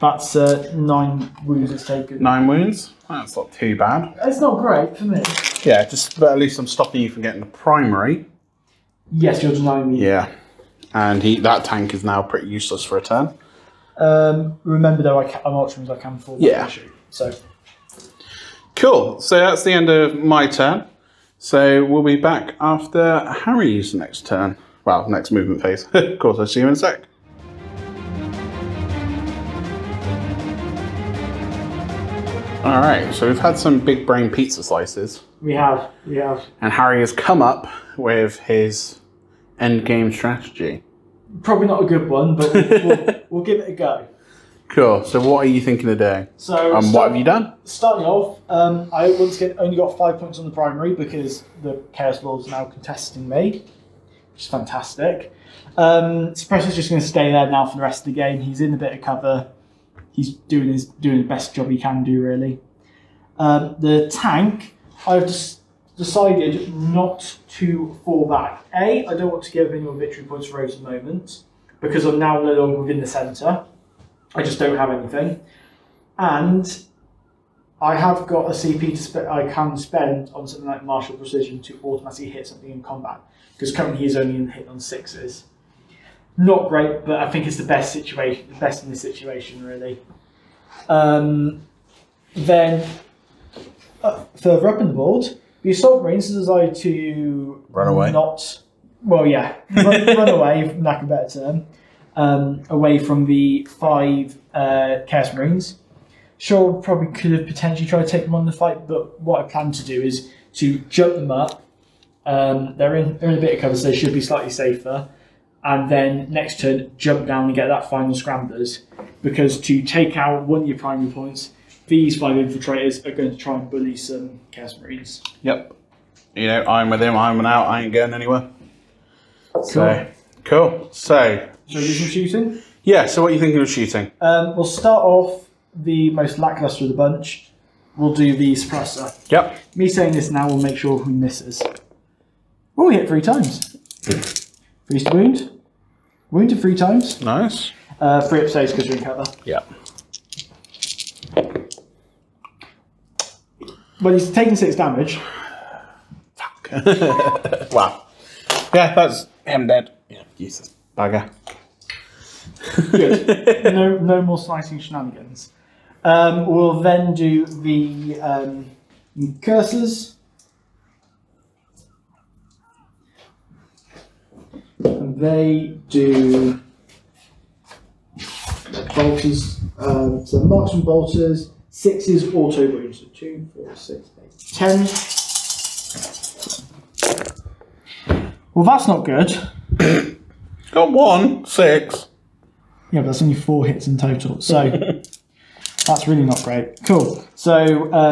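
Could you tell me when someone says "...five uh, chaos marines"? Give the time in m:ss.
1:43.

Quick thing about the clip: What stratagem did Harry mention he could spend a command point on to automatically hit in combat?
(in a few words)
martial precision.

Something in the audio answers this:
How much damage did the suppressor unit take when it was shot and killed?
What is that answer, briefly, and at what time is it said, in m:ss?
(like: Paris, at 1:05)
6, at 2:34.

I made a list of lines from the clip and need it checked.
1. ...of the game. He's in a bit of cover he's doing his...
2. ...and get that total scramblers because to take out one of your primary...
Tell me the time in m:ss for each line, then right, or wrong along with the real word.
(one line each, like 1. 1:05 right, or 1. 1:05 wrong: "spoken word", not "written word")
1. 0:58 right
2. 1:57 wrong: "final", not "total".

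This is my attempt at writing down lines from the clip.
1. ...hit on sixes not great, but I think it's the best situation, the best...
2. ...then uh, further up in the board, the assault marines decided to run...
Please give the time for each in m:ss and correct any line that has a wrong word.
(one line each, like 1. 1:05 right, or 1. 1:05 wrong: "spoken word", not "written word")
1. 1:24 right
2. 1:32 right.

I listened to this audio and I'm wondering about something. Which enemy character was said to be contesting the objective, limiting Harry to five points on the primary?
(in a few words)
Chaos Lord.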